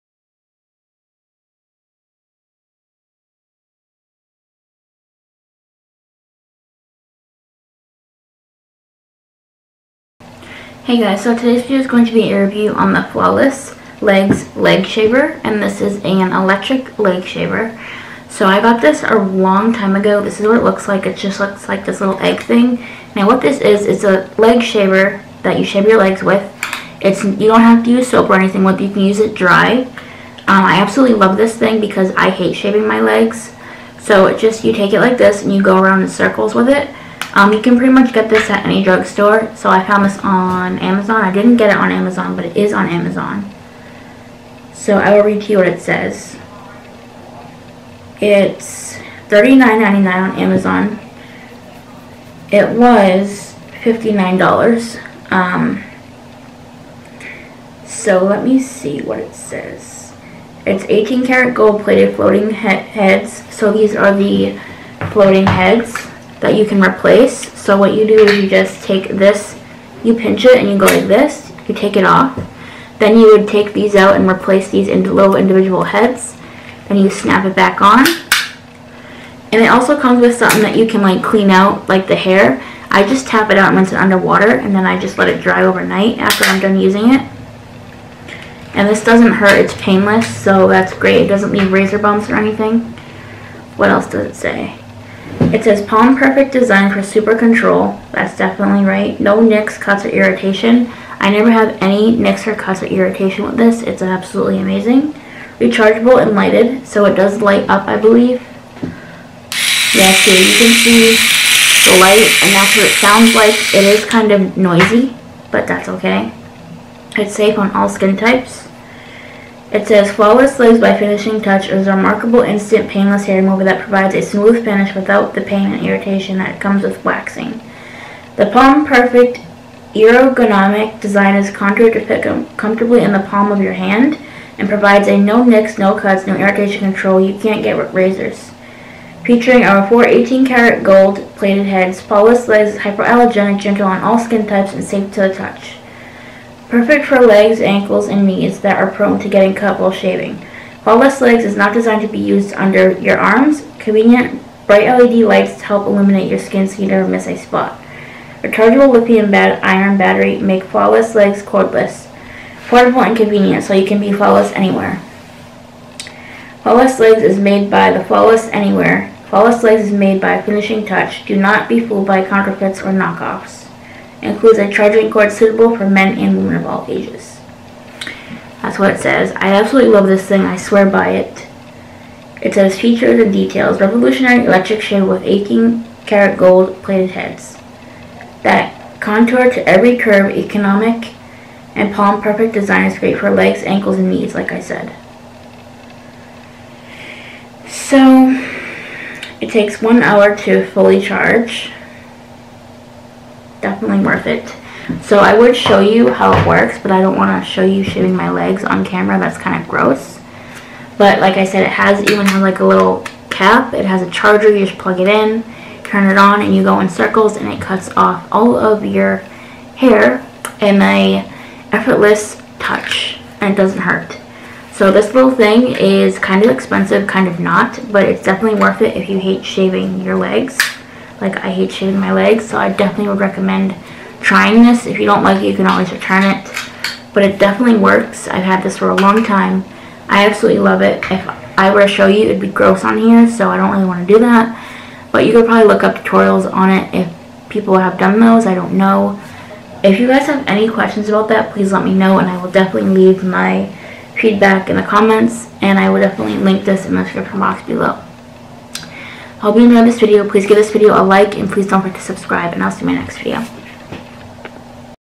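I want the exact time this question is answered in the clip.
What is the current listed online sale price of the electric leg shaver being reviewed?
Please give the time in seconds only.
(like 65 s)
49 s.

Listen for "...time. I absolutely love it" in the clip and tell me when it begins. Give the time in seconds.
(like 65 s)
239 s.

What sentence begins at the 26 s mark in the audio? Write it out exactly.
It's You don't have to use soap or anything with You can use it dry.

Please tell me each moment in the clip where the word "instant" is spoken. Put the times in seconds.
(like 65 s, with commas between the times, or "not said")
122 s.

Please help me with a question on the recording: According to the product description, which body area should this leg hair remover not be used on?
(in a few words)
under your arms.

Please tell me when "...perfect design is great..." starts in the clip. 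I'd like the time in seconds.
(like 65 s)
192 s.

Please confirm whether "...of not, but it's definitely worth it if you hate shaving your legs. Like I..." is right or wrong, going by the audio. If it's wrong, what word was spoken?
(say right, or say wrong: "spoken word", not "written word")
right.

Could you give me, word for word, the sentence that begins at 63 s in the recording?
So these are the floating heads that you can replace.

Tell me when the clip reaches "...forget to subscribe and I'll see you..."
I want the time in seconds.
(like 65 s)
261 s.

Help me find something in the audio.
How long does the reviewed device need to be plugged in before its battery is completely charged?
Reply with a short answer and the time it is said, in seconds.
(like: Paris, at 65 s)
one hour, at 199 s.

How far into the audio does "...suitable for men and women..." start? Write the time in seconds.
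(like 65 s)
175 s.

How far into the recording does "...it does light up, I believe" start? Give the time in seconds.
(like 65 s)
107 s.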